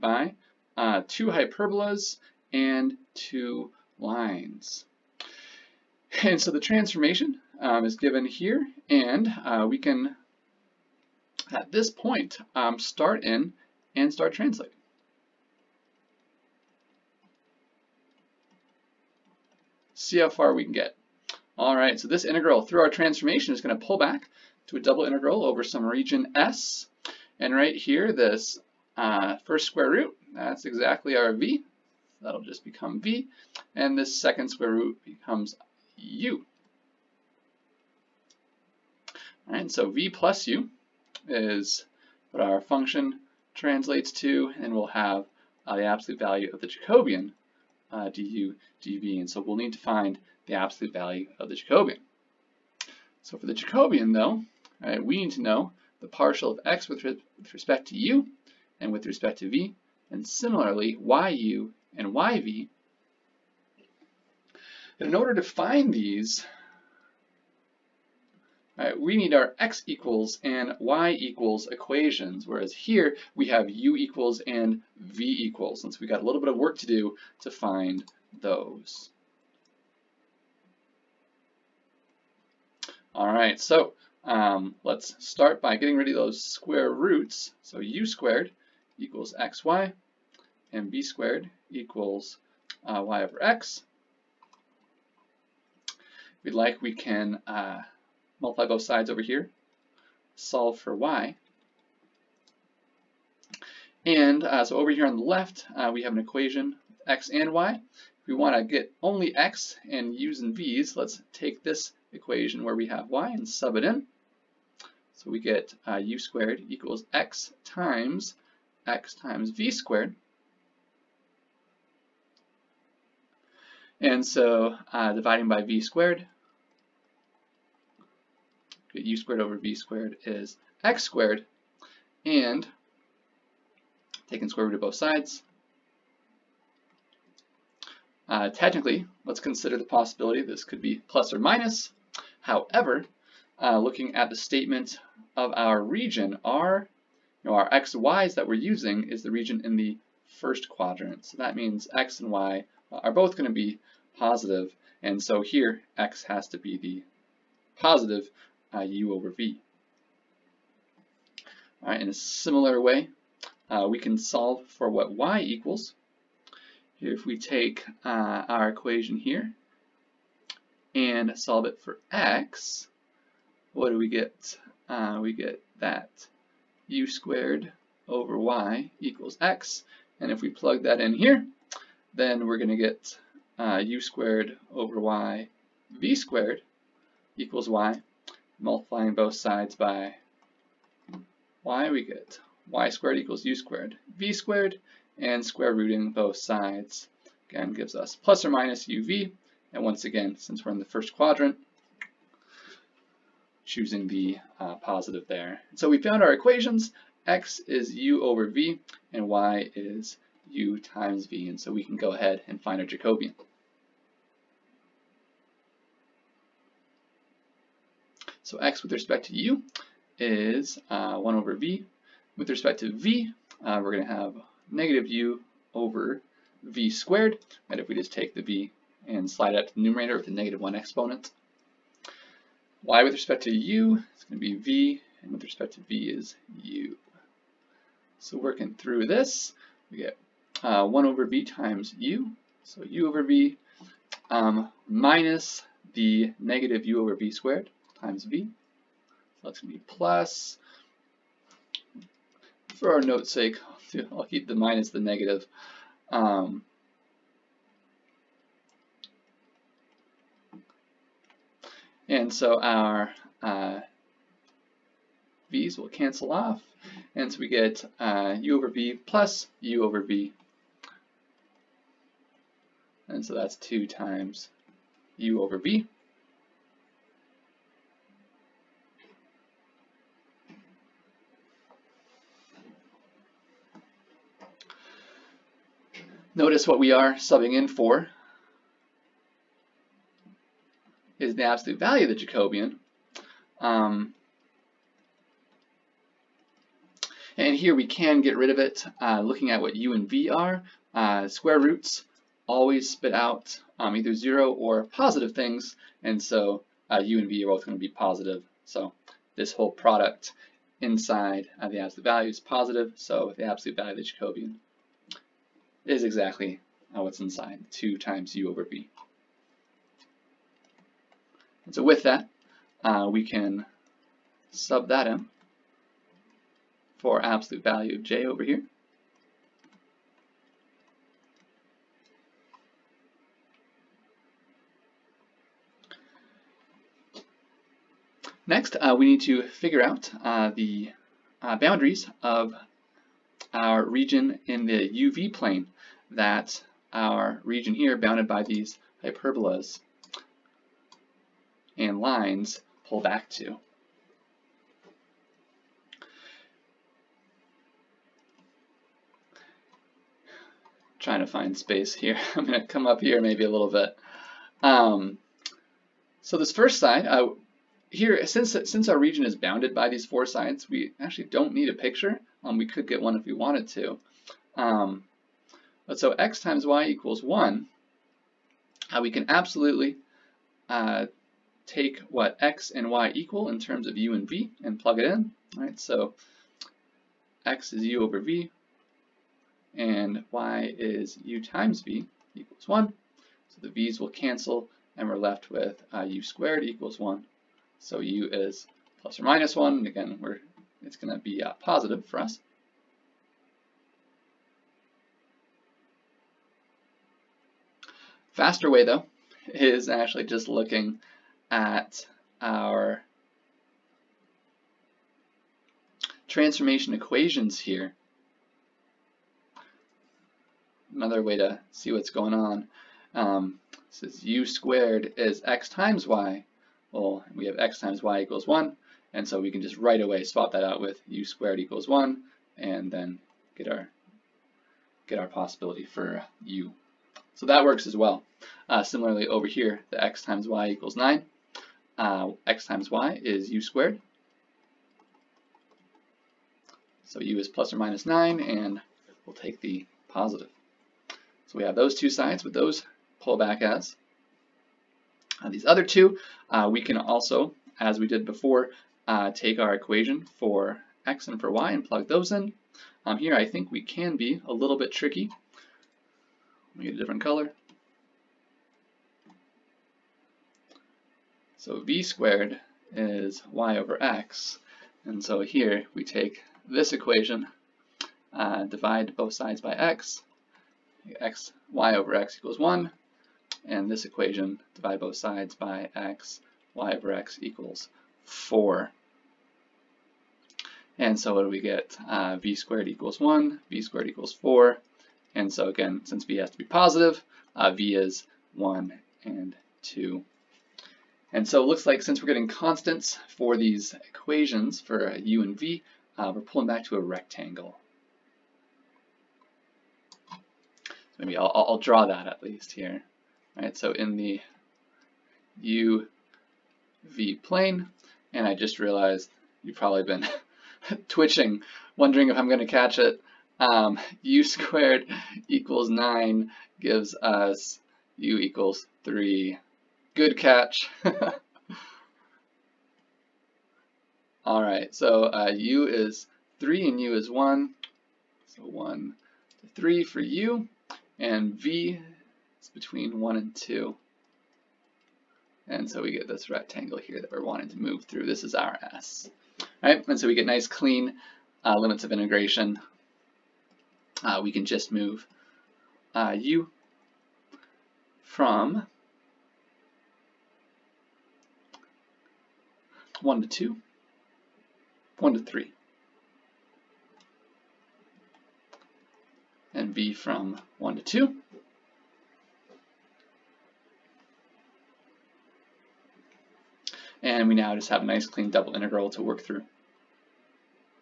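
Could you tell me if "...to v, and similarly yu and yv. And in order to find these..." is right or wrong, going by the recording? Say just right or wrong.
right.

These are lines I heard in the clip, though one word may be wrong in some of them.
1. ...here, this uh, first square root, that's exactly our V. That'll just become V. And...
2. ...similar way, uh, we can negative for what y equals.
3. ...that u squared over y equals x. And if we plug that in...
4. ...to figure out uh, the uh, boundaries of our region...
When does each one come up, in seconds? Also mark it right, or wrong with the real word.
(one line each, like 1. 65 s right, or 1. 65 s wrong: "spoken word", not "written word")
1. 27 s right
2. 162 s wrong: "solve", not "negative"
3. 175 s right
4. 339 s right.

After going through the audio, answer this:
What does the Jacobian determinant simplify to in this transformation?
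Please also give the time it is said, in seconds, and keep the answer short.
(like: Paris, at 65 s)
2 times u over v, at 273 s.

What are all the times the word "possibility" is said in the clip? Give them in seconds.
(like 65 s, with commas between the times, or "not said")
139 s, 435 s.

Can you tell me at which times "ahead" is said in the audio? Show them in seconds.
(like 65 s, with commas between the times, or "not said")
212 s.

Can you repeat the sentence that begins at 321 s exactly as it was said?
And so with that, uh, we can sub that in for absolute value of j over here.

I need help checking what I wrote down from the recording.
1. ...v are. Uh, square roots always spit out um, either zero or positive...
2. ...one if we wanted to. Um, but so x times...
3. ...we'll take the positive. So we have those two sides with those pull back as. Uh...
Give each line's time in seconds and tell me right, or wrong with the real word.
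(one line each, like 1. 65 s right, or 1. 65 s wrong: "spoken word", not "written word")
1. 300 s right
2. 373 s right
3. 449 s right.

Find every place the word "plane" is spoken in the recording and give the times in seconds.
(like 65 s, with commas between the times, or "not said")
345 s, 517 s.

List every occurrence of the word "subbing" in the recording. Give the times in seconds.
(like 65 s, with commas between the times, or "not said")
287 s.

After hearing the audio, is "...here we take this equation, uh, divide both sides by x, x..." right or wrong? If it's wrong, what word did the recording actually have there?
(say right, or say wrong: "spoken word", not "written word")
right.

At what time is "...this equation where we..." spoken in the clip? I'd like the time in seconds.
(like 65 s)
111 s.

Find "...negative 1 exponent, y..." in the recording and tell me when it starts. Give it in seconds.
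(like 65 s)
230 s.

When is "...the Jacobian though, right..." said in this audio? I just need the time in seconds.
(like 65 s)
53 s.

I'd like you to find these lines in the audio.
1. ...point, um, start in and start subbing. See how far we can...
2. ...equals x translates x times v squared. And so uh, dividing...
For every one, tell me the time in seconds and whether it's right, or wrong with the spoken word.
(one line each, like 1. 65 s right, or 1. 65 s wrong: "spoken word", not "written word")
1. 11 s wrong: "translating", not "subbing"
2. 116 s wrong: "times", not "translates".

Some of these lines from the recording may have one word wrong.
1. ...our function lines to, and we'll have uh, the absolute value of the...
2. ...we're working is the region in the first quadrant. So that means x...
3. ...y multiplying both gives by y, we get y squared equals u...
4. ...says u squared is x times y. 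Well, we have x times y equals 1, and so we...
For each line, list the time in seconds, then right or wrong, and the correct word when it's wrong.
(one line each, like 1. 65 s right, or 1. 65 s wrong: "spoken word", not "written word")
1. 42 s wrong: "translates", not "lines"
2. 148 s wrong: "using", not "working"
3. 187 s wrong: "sides", not "gives"
4. 423 s right.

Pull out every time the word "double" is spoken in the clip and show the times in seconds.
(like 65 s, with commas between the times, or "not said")
24 s, 578 s.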